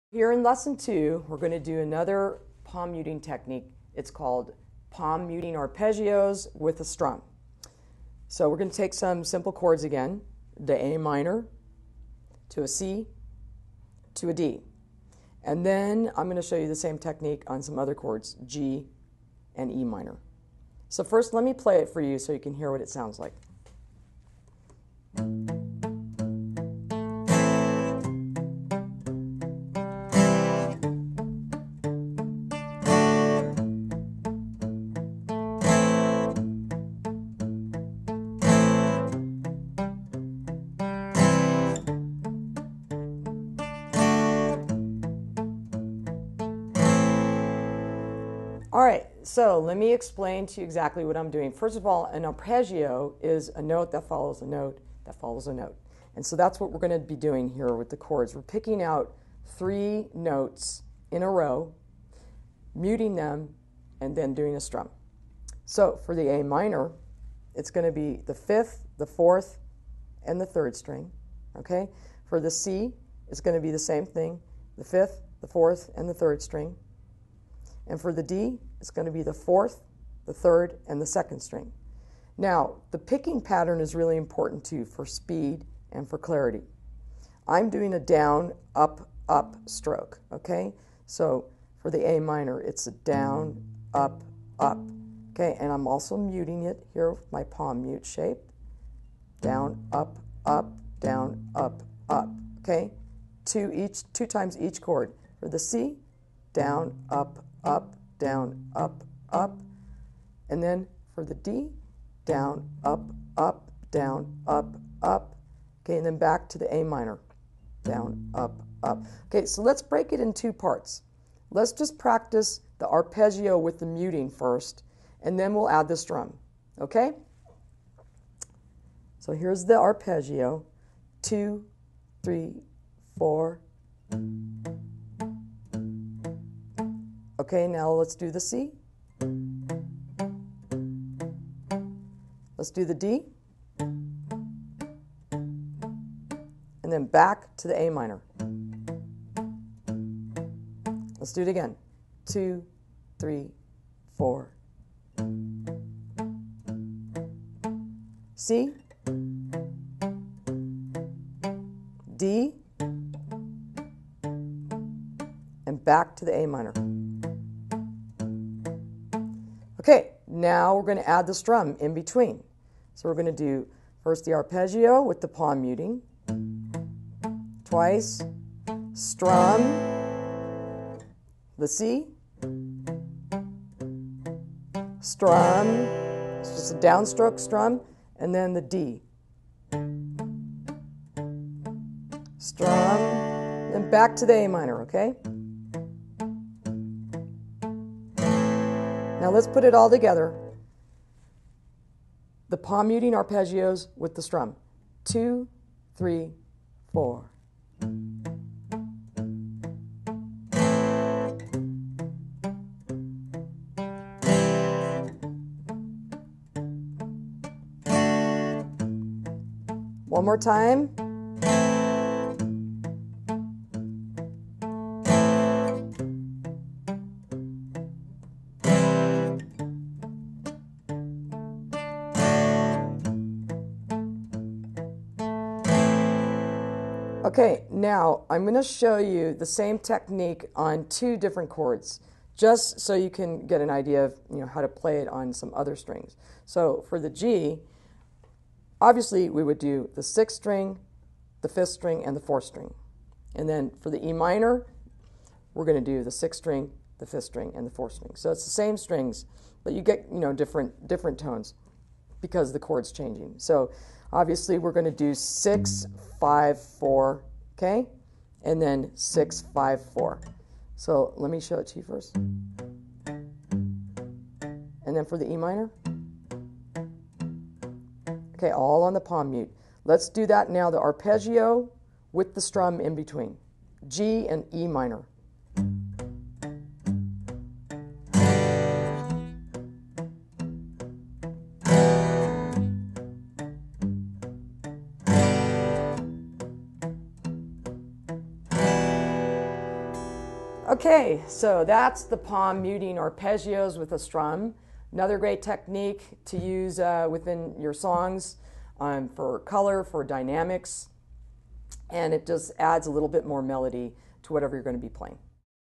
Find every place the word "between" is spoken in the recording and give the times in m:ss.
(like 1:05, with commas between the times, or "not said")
2:51, 4:42.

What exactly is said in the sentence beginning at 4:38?
Okay, all on the palm mute.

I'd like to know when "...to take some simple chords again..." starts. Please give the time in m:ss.
0:08.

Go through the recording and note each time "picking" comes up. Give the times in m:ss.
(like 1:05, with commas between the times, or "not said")
0:58, 1:22.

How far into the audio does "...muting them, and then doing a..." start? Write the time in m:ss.
1:02.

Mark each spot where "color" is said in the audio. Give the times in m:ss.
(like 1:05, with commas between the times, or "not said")
5:09.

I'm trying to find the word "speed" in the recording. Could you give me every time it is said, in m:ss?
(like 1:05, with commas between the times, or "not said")
1:25.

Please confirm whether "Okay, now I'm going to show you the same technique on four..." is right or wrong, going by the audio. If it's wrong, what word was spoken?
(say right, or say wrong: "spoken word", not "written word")
wrong: "two", not "four".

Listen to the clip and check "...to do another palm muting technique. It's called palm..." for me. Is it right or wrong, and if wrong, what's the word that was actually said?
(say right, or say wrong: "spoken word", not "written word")
right.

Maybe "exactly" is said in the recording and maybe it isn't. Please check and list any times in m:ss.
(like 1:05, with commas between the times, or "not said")
0:50.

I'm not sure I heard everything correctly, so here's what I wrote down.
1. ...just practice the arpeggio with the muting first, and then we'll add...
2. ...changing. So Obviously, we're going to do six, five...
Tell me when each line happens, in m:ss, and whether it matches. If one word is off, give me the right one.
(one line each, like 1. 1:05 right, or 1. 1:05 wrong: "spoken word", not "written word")
1. 2:01 right
2. 4:22 right.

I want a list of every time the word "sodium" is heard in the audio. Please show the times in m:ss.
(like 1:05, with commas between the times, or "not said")
not said.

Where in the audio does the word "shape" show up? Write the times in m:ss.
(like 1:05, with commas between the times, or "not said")
1:38.